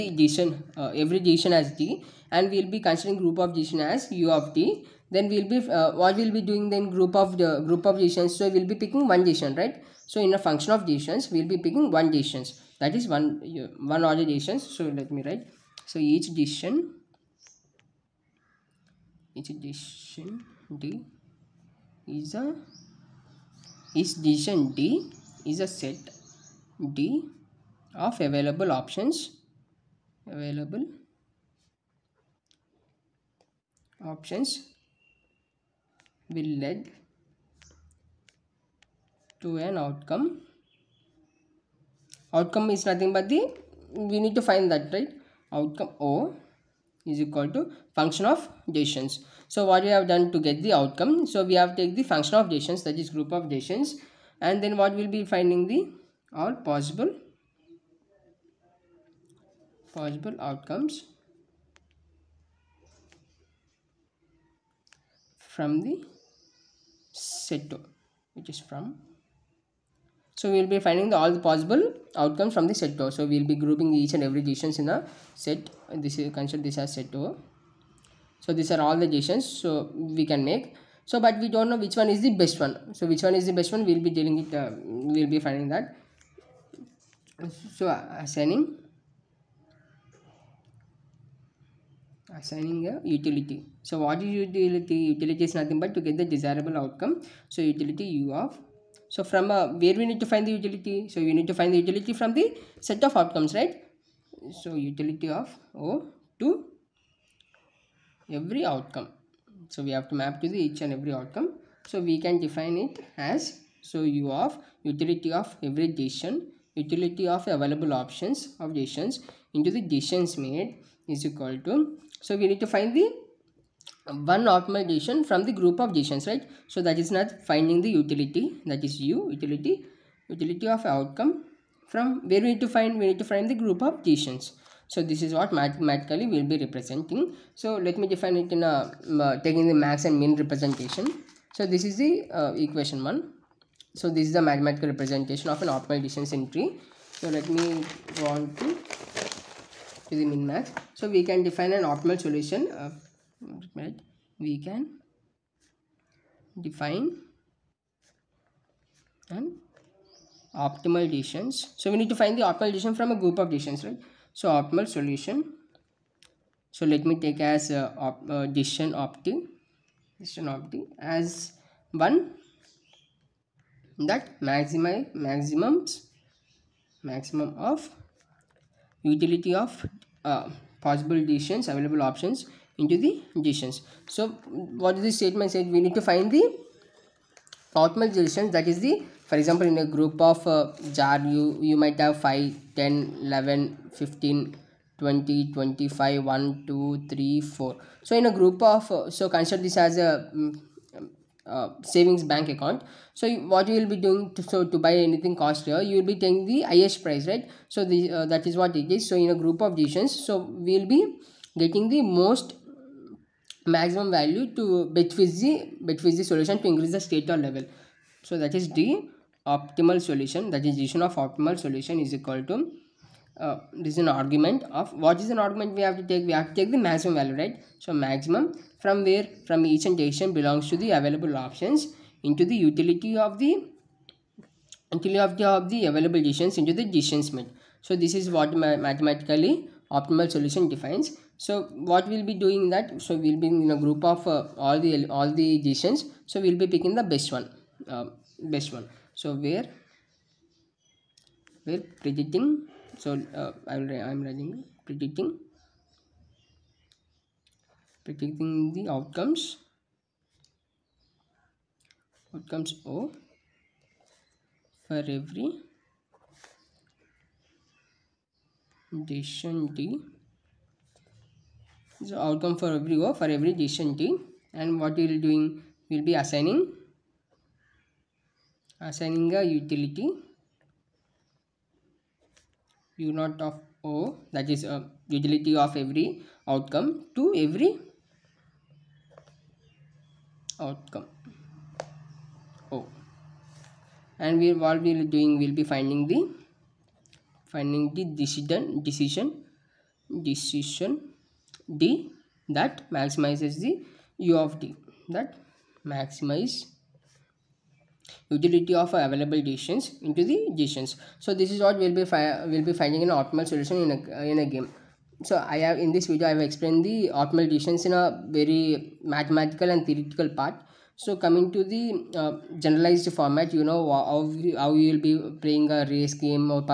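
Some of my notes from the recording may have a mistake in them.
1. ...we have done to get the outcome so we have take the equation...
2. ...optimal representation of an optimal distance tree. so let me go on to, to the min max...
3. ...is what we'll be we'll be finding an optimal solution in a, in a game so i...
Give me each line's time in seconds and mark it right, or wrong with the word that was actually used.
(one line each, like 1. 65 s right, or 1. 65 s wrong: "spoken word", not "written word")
1. 49 s wrong: "function", not "equation"
2. 144 s wrong: "mathematical", not "optimal"
3. 311 s right.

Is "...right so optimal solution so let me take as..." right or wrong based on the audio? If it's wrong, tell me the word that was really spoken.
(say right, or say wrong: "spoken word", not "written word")
right.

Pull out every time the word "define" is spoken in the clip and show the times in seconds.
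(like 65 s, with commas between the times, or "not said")
112 s, 138 s, 151 s, 156 s, 240 s.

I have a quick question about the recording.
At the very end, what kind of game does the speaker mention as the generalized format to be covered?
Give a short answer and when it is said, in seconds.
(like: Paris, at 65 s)
race game, at 325 s.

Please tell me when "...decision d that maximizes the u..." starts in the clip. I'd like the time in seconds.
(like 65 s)
300 s.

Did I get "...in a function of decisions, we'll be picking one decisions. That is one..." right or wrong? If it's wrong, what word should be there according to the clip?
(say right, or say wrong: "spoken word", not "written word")
right.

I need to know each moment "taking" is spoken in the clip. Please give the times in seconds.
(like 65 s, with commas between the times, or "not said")
139 s, 206 s.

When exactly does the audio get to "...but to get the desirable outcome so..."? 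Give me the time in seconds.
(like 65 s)
95 s.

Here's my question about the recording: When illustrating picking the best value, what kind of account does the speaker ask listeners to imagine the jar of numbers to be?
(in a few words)
savings bank account.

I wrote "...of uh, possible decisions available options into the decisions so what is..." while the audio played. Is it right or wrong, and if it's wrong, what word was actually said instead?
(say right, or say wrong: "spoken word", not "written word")
right.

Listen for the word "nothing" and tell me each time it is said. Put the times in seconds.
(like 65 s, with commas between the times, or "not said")
42 s, 95 s.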